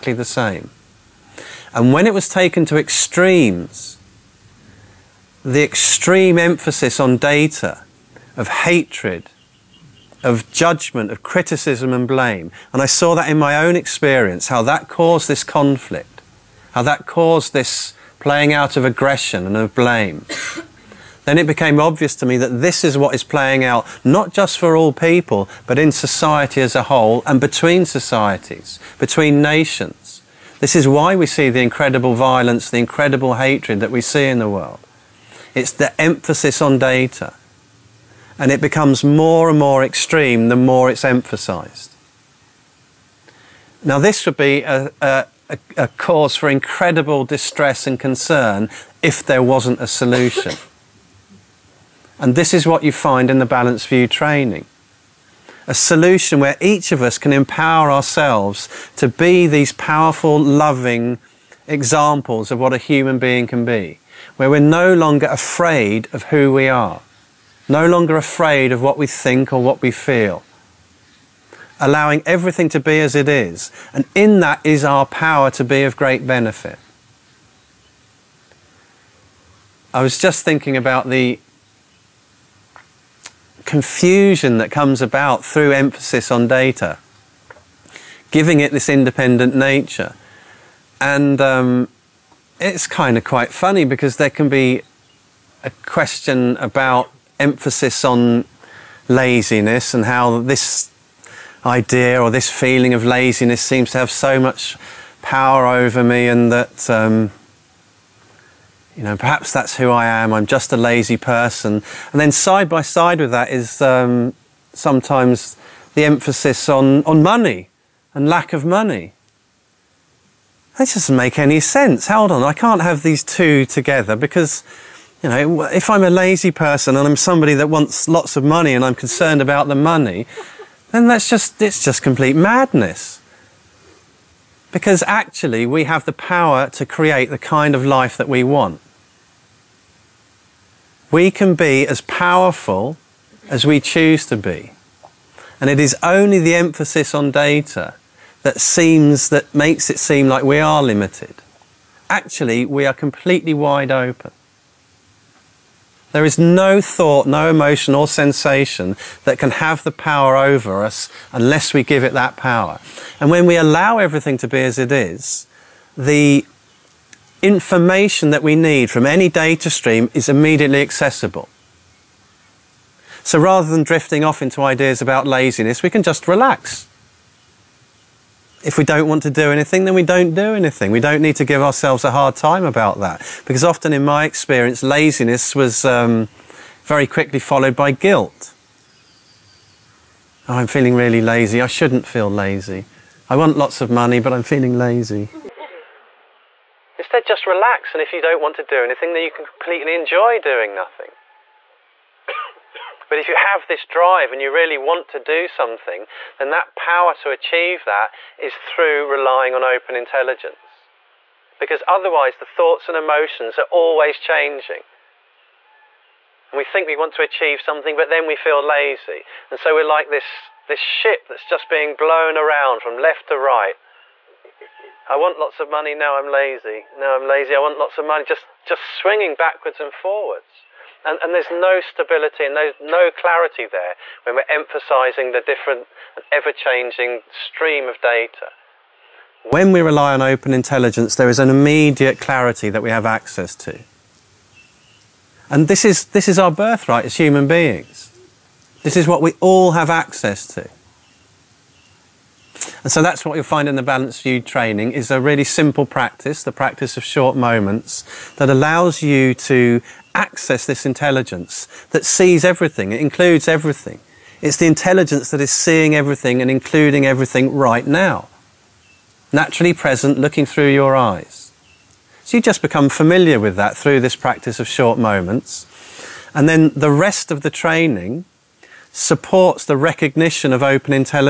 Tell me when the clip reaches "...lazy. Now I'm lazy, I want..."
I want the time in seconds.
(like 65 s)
226 s.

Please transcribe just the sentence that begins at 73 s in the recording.
And in that is our power to be of great benefit.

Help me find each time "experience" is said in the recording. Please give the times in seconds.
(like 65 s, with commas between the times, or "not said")
13 s, 184 s.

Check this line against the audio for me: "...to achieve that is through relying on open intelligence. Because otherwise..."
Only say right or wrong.
right.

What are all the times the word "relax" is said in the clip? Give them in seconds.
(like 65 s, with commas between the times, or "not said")
176 s, 197 s.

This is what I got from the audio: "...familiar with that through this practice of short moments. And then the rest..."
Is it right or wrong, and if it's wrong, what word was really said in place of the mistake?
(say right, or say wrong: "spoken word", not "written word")
right.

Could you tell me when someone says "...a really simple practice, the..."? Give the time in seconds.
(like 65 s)
255 s.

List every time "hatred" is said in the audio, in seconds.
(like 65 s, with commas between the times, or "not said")
8 s, 33 s.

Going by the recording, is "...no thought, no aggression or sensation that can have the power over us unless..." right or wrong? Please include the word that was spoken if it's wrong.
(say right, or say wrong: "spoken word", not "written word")
wrong: "emotion", not "aggression".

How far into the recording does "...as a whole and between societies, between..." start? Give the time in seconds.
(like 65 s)
26 s.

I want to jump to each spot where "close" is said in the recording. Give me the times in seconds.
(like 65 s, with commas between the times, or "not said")
not said.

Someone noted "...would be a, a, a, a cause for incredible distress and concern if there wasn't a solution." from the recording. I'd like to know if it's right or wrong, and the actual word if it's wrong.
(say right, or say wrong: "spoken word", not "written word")
right.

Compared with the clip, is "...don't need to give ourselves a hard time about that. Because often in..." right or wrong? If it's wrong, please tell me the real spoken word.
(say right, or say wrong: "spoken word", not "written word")
right.